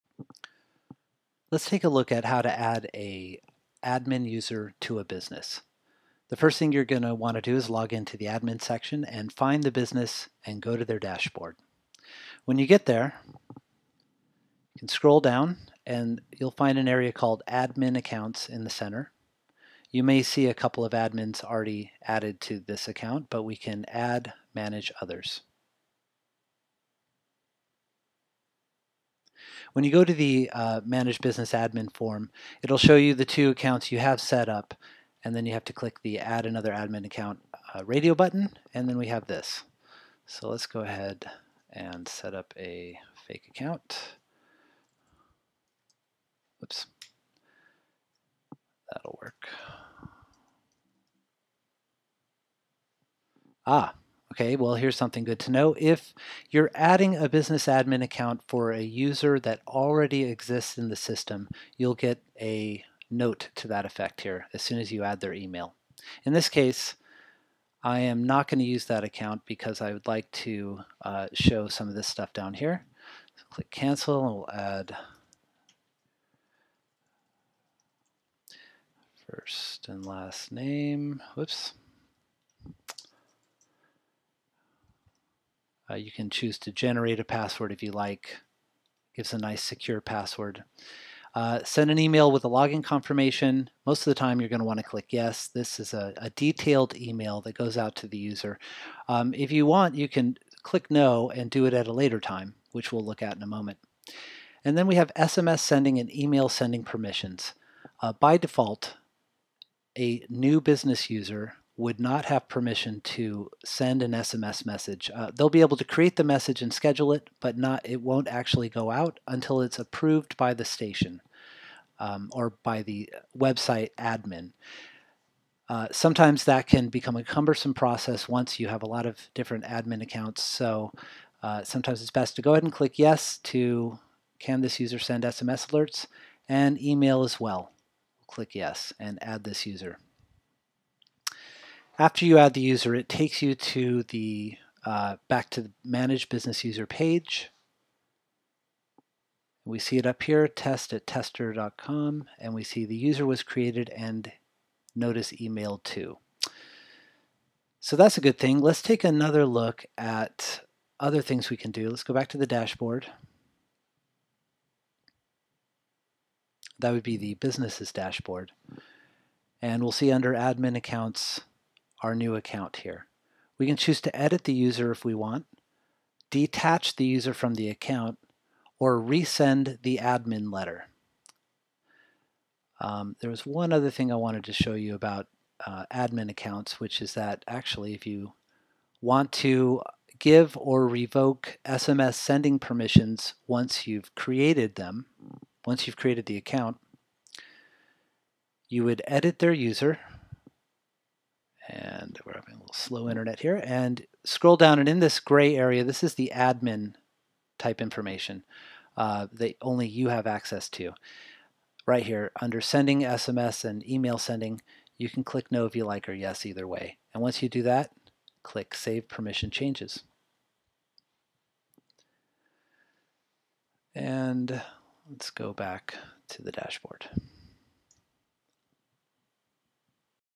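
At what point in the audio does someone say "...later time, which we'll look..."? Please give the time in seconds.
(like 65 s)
101 s.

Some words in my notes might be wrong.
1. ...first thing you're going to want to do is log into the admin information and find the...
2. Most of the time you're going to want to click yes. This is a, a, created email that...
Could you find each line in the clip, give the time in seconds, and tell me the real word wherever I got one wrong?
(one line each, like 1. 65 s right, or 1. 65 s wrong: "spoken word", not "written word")
1. 6 s wrong: "section", not "information"
2. 93 s wrong: "detailed", not "created".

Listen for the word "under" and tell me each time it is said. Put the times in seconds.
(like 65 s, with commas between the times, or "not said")
170 s, 212 s.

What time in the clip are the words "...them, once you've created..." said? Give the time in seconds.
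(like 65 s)
194 s.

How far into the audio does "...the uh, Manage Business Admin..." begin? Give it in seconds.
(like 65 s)
30 s.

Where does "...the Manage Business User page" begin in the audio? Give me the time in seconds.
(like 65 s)
145 s.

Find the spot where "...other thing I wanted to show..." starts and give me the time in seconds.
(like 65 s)
183 s.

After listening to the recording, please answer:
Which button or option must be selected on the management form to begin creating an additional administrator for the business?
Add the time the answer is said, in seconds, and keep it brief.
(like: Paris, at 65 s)
Add Another Admin Account, at 36 s.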